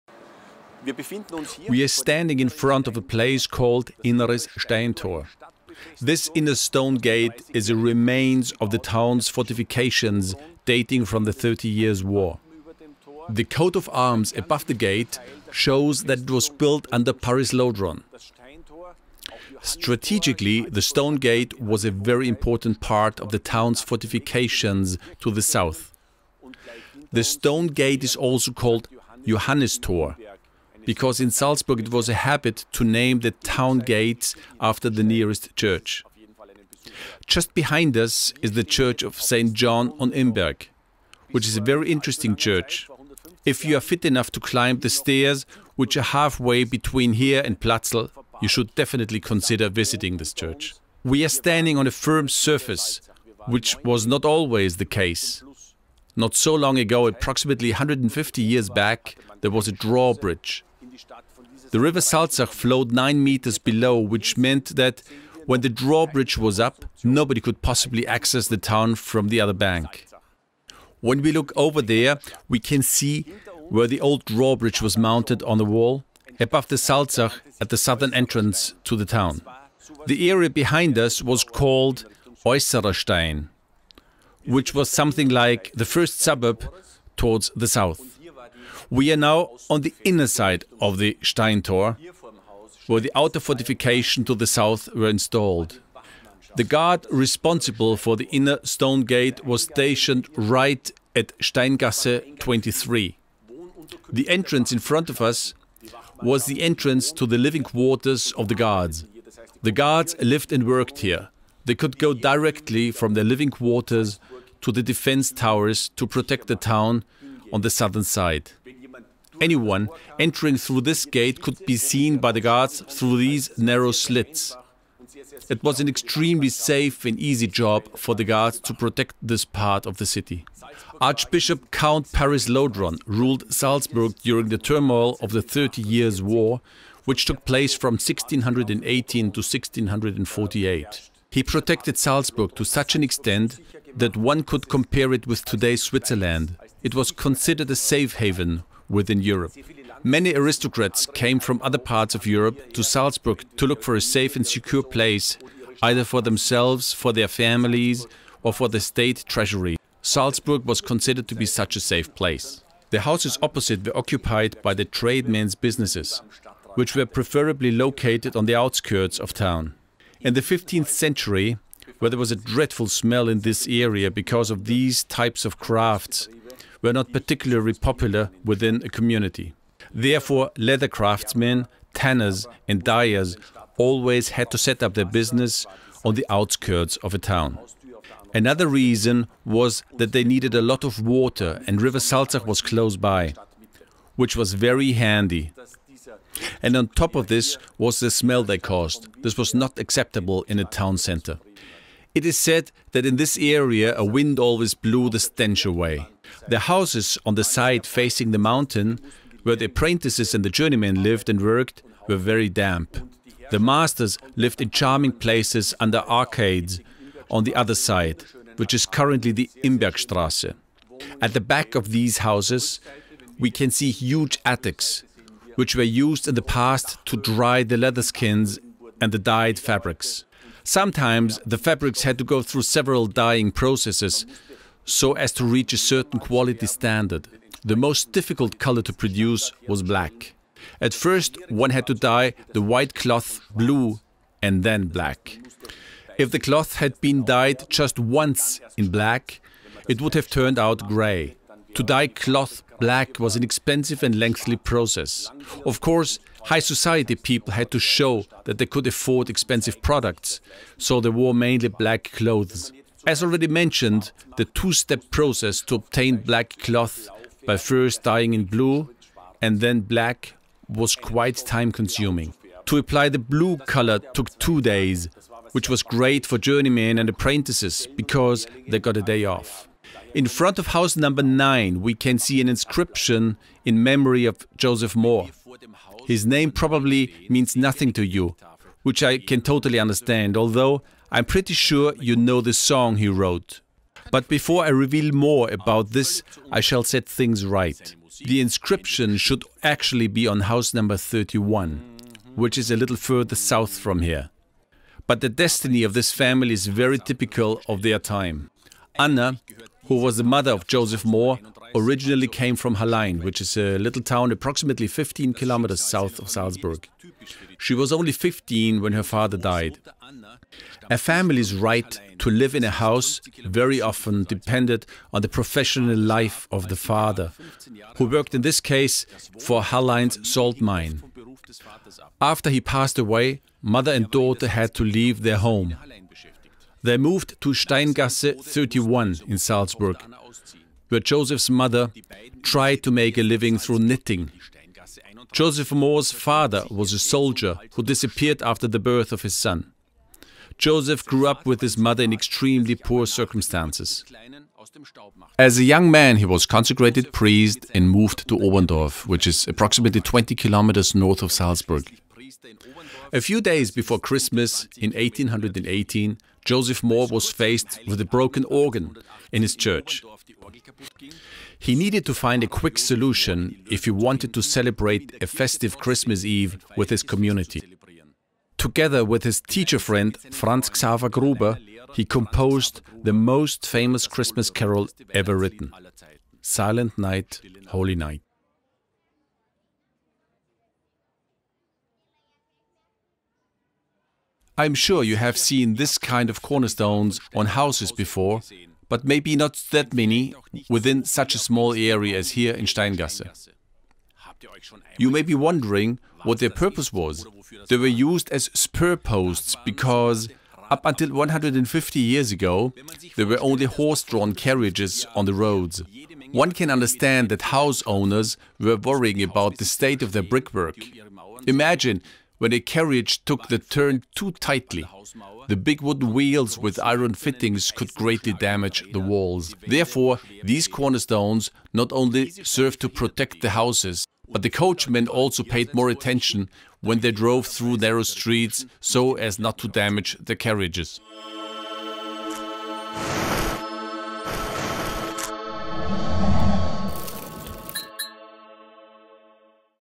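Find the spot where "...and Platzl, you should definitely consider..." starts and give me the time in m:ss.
0:47.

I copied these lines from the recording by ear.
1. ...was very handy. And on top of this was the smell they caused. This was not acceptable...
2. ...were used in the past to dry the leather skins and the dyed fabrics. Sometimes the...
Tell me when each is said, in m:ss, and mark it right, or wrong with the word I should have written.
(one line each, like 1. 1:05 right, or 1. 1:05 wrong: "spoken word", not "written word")
1. 3:14 right
2. 3:45 right.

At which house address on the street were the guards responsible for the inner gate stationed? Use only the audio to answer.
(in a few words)
Steingasse 23.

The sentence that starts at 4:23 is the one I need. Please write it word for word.
As already mentioned, the two-step process to obtain black cloth by first dyeing in blue and then black was quite time-consuming.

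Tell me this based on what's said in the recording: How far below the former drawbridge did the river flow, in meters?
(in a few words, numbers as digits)
9 meters.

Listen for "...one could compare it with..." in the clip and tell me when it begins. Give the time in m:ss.
2:24.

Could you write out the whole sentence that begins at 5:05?
But the destiny of this family is very typical of their time.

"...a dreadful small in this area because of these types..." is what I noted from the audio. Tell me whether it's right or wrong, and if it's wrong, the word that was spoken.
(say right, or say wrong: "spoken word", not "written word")
wrong: "smell", not "small".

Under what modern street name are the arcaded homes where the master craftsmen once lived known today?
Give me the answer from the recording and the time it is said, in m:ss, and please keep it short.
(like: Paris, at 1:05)
Imbergstrasse, at 3:39.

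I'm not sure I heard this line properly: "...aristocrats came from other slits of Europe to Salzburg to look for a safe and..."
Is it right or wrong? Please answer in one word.
wrong.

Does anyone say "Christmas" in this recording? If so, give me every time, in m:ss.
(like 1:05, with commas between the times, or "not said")
6:03, 6:15, 6:24.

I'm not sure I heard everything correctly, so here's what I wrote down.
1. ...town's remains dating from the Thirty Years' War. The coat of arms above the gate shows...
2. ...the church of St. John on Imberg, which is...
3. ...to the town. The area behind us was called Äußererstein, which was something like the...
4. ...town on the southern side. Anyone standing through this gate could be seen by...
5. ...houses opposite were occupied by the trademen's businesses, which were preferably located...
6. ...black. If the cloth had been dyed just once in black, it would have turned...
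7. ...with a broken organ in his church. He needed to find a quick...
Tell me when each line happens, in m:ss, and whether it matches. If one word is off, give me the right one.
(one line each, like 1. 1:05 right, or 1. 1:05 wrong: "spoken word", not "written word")
1. 0:08 wrong: "fortifications", not "remains"
2. 0:38 right
3. 1:18 right
4. 1:56 wrong: "entering", not "standing"
5. 2:43 right
6. 4:04 right
7. 6:07 right.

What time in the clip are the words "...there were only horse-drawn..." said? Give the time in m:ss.
6:53.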